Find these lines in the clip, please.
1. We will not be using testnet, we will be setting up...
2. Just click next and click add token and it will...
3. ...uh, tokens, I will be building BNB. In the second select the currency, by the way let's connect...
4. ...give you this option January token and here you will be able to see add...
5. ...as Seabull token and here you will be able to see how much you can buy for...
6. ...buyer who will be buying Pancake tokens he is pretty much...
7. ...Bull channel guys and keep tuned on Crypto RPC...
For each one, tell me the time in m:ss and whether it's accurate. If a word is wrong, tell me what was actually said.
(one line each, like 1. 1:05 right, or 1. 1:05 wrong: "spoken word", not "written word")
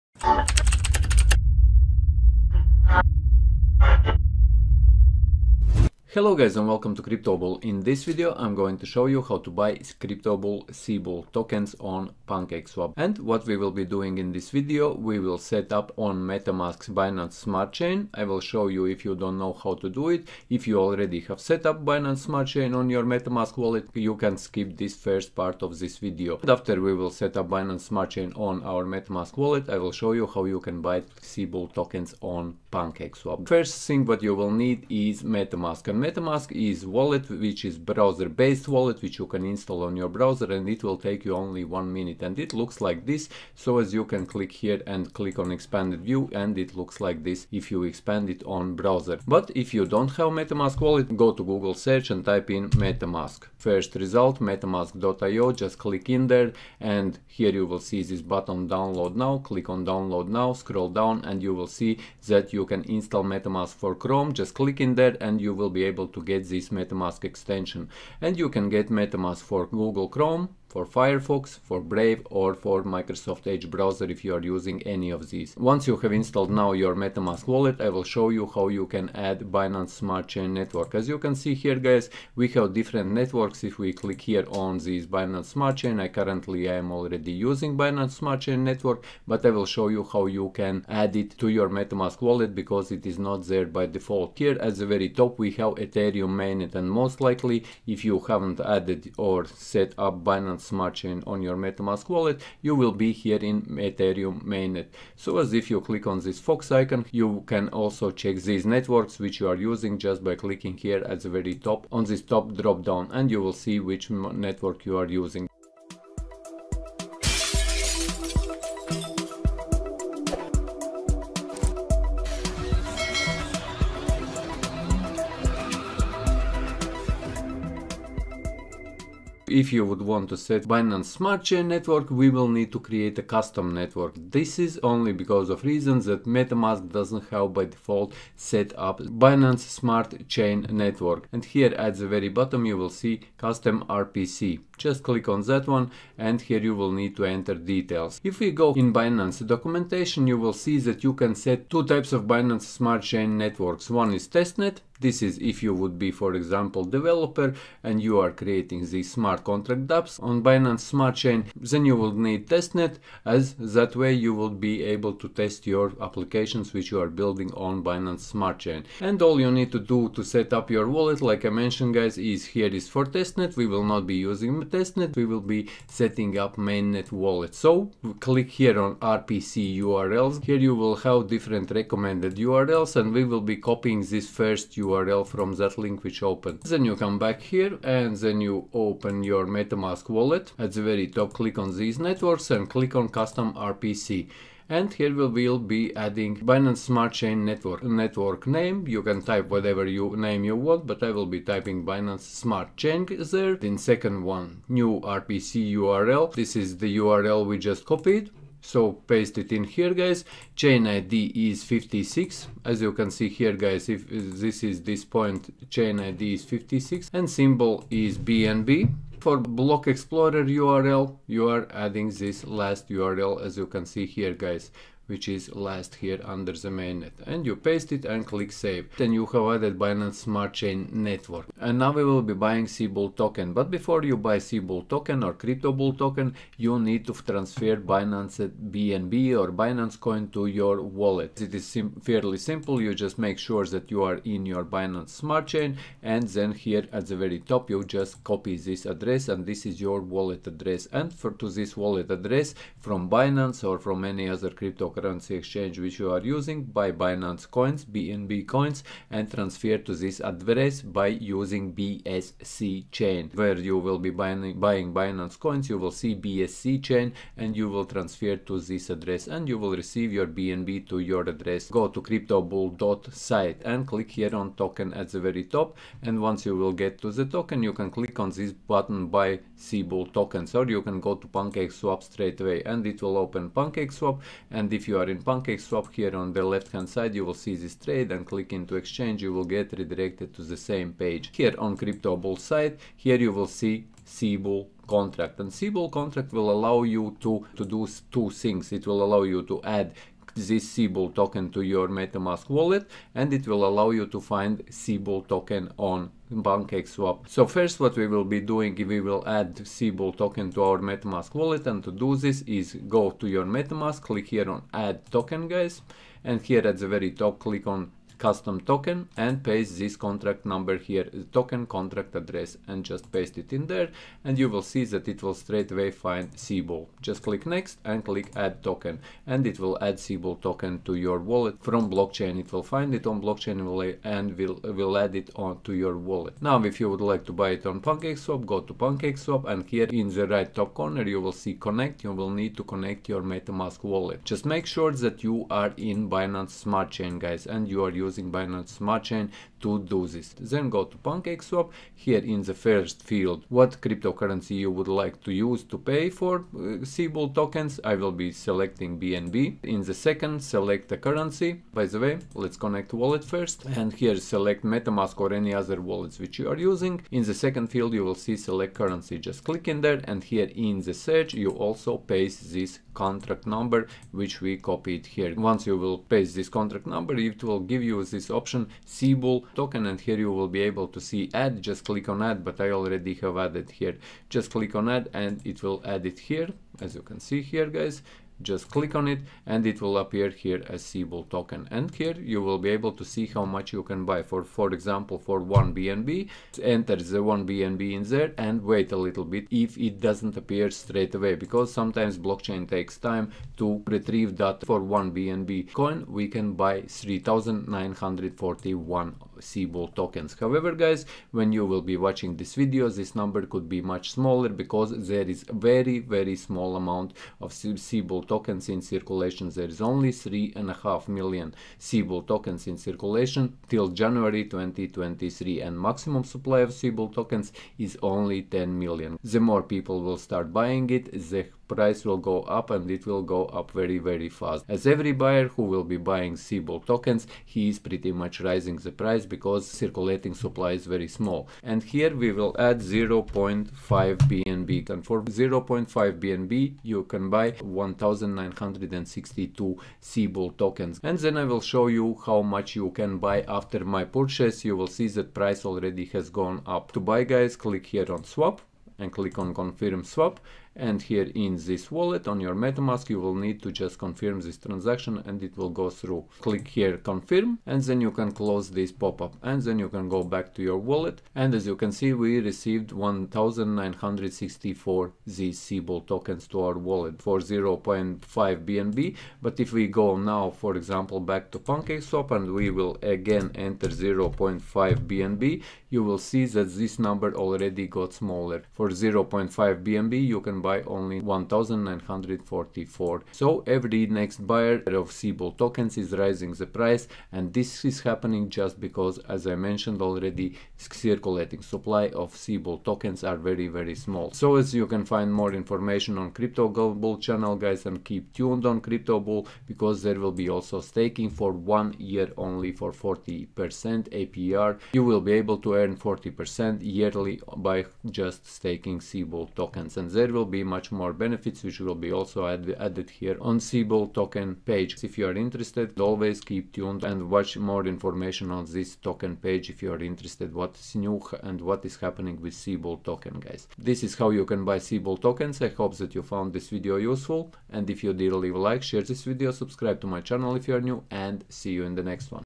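1. 2:53 right
2. 5:27 right
3. 5:56 wrong: "selecting", not "building"
4. 6:17 wrong: "Seabull", not "January"
5. 6:30 right
6. 7:15 wrong: "Seabull", not "Pancake"
7. 8:26 wrong: "Bull", not "RPC".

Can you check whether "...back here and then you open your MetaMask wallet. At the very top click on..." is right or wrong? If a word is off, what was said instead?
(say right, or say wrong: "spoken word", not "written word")
right.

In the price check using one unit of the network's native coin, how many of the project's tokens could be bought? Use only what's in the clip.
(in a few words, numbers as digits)
3941.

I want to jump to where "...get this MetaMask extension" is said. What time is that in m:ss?
1:06.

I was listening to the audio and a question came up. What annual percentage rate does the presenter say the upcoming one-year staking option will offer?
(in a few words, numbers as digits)
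40%.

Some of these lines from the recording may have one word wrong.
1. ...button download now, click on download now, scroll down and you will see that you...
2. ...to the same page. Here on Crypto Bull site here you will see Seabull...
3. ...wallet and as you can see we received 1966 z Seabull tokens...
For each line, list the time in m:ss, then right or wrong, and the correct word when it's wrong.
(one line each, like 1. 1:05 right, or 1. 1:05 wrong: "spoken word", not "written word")
1. 0:58 right
2. 4:50 right
3. 7:50 wrong: "1964", not "1966".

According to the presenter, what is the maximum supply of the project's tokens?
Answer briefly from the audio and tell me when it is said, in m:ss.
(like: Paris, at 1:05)
10 million, at 7:08.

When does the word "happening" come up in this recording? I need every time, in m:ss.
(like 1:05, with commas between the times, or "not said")
8:18, 8:51.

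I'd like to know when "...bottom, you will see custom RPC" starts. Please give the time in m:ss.
2:22.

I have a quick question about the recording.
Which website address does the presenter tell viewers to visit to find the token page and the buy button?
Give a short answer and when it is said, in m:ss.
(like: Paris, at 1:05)
cryptobull.site, at 4:32.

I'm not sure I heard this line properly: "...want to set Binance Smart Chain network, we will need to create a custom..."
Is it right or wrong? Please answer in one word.
right.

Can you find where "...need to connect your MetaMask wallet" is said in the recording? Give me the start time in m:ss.
5:42.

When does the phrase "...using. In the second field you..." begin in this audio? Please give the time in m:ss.
6:06.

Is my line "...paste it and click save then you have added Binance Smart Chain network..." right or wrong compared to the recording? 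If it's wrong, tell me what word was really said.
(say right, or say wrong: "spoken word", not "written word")
right.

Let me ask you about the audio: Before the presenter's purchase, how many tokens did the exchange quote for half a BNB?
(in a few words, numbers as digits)
1962.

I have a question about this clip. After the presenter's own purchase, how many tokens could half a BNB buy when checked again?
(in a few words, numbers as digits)
1944.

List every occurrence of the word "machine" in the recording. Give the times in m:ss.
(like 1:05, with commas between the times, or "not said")
not said.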